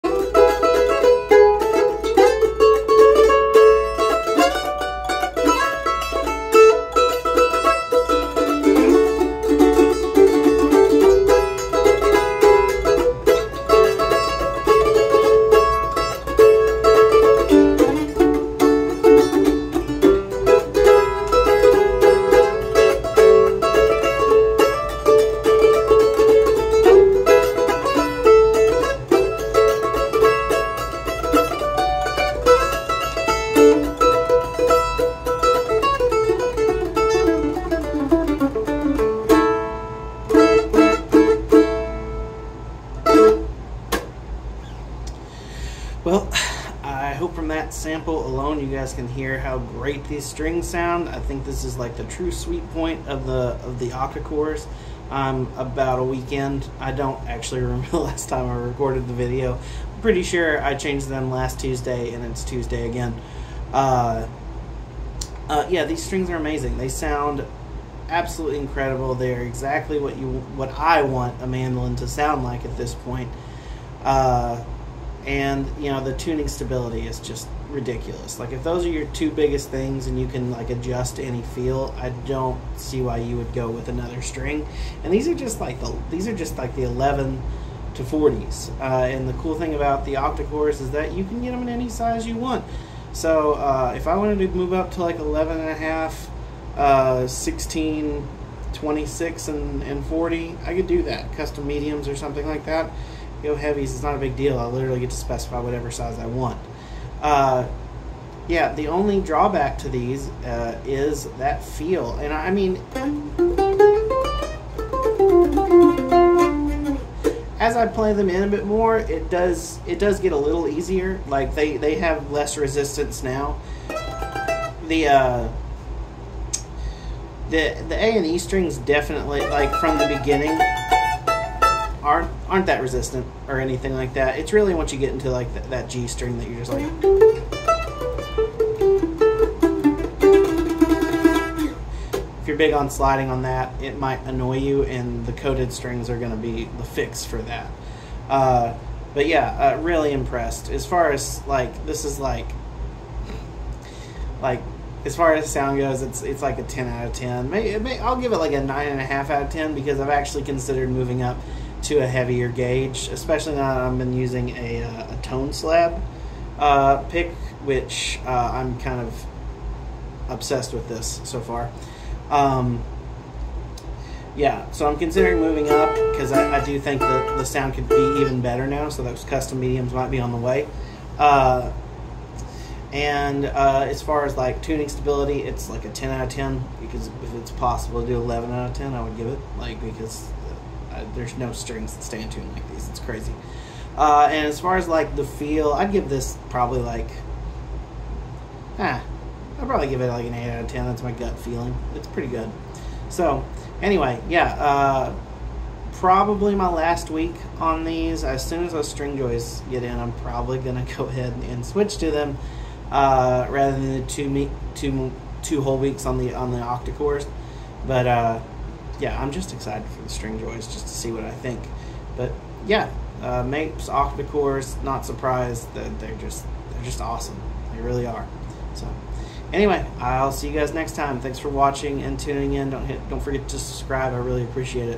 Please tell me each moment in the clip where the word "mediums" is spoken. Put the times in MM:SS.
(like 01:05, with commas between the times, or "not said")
01:41, 02:59.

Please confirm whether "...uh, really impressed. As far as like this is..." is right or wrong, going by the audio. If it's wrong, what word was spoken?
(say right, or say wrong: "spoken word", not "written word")
right.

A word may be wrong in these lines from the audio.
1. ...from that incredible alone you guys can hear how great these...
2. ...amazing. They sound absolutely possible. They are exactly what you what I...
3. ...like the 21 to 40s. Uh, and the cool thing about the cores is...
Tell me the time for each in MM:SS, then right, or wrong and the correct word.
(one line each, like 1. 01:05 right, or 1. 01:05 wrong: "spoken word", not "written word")
1. 00:47 wrong: "sample", not "incredible"
2. 01:06 wrong: "incredible", not "possible"
3. 01:26 wrong: "11", not "21".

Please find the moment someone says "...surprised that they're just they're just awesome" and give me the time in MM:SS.
03:45.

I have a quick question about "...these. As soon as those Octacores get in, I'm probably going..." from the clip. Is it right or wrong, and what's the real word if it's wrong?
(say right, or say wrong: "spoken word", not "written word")
wrong: "Stringjoys", not "Octacores".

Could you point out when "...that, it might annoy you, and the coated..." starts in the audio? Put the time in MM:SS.
02:23.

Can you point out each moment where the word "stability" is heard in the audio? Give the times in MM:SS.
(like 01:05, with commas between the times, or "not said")
01:16, 03:04.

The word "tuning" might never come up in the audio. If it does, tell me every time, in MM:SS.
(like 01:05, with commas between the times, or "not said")
01:16, 03:04, 03:52.